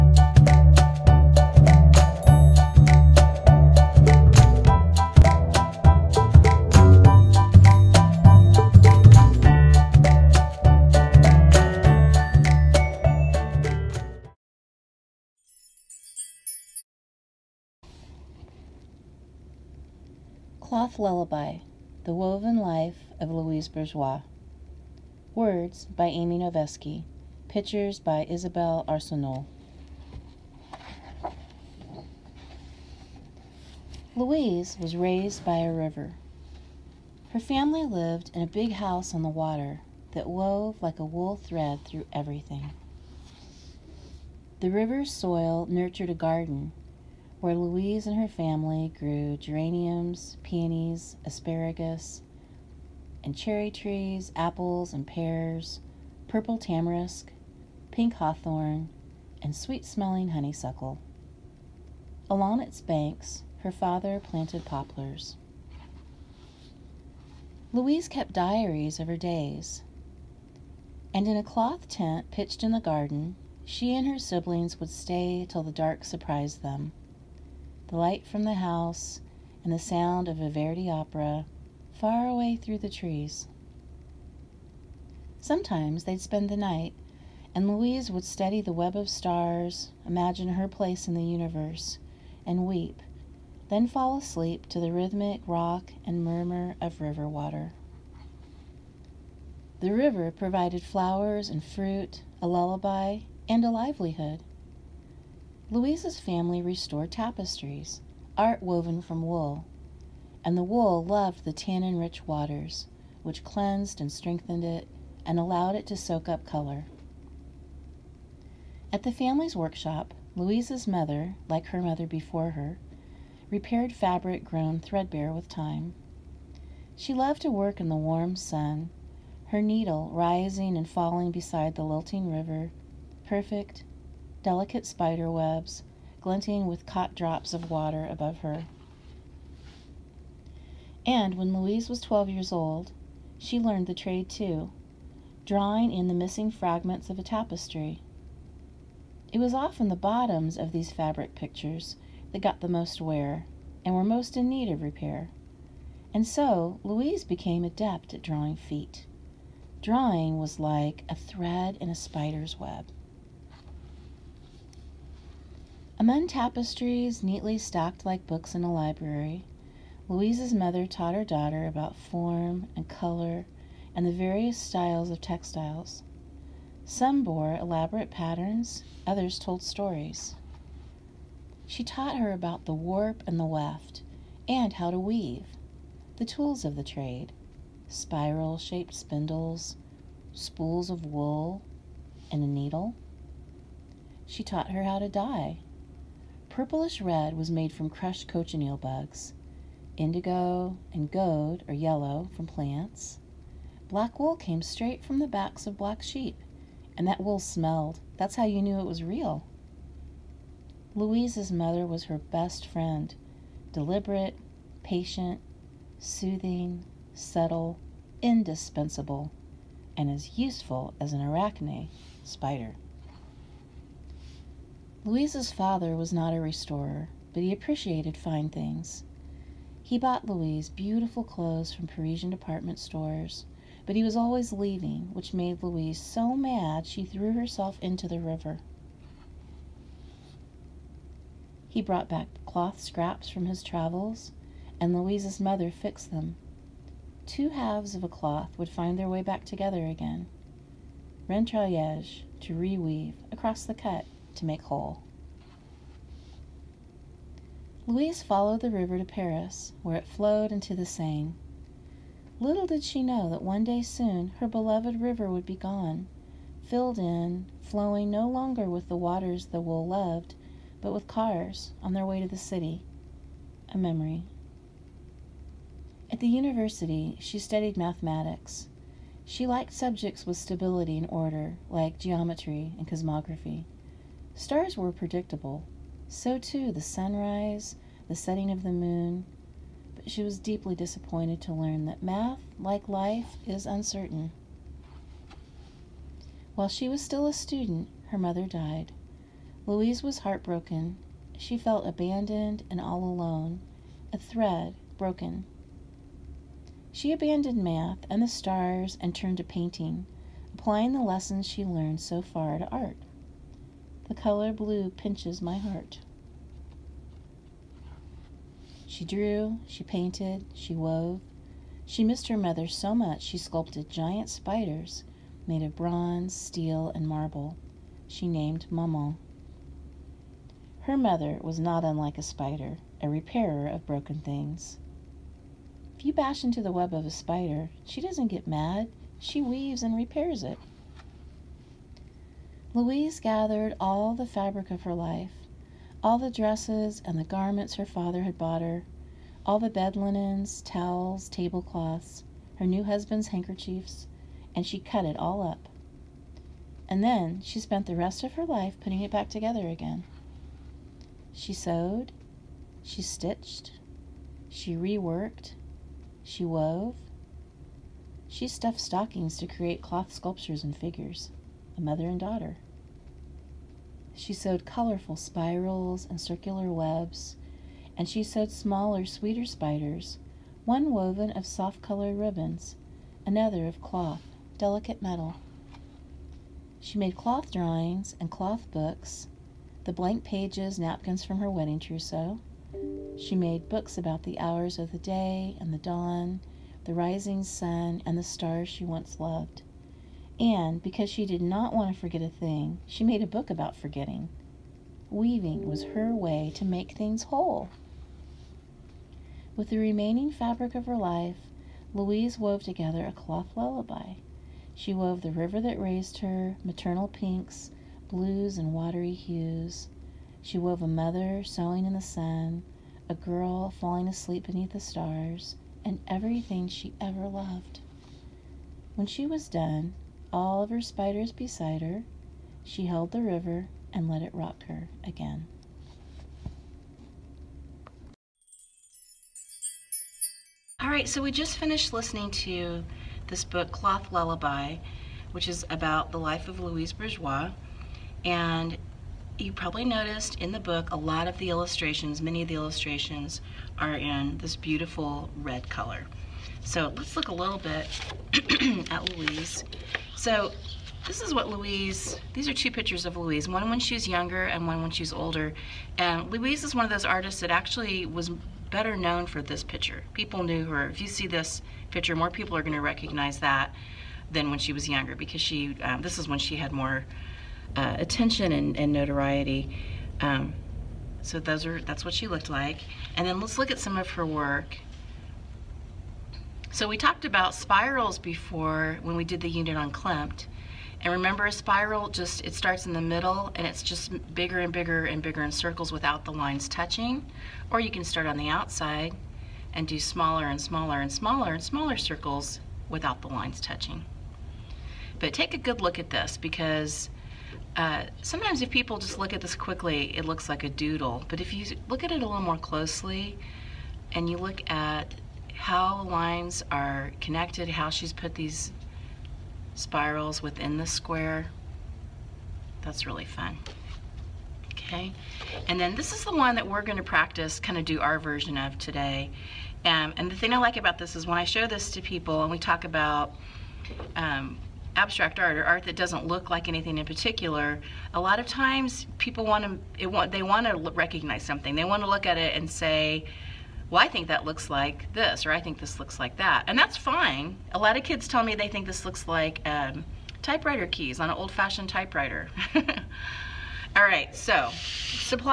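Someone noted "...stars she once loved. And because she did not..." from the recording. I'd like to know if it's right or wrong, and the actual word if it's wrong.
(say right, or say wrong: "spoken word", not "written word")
right.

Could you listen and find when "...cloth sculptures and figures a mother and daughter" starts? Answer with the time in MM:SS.
06:09.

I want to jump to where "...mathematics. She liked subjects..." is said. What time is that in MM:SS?
04:37.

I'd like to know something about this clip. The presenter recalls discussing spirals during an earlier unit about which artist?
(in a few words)
Klimt.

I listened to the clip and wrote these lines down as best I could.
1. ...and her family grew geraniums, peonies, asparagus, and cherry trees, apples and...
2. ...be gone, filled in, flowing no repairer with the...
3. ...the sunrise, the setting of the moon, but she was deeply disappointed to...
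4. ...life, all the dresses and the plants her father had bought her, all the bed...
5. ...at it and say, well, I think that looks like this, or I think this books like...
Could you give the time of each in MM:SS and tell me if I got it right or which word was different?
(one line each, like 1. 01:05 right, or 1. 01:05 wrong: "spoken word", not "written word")
1. 00:48 right
2. 04:25 wrong: "longer", not "repairer"
3. 04:46 right
4. 05:44 wrong: "garments", not "plants"
5. 09:02 wrong: "looks", not "books".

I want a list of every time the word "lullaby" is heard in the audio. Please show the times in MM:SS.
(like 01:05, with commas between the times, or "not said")
00:20, 01:42, 06:53, 07:24.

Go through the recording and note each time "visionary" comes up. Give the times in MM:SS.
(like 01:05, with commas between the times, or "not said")
not said.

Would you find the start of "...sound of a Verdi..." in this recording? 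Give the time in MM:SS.
01:19.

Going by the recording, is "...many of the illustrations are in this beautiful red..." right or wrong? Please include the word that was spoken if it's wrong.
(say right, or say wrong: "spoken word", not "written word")
right.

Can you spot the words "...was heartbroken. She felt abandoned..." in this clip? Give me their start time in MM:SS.
05:00.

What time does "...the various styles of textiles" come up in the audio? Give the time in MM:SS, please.
02:54.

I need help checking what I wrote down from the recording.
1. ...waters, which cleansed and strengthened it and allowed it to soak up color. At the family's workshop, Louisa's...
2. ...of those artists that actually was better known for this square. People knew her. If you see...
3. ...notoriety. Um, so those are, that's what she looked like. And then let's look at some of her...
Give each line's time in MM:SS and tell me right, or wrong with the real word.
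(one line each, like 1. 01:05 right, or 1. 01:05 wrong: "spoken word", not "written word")
1. 01:52 right
2. 07:46 wrong: "picture", not "square"
3. 07:58 right.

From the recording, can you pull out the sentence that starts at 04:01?
He brought back cloth scraps from his travels, and Louise's mother fixed them.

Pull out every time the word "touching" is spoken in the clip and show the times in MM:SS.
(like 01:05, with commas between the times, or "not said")
08:16, 08:23.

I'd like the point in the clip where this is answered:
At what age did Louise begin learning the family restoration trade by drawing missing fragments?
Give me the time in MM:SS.
02:22.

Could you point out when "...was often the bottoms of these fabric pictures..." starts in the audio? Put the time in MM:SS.
02:29.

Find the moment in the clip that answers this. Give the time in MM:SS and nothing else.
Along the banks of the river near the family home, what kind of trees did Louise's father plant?
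01:04.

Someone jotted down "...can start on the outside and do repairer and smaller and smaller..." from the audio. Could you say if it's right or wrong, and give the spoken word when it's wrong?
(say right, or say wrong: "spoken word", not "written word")
wrong: "smaller", not "repairer".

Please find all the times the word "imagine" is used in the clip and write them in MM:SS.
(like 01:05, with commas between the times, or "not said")
01:30.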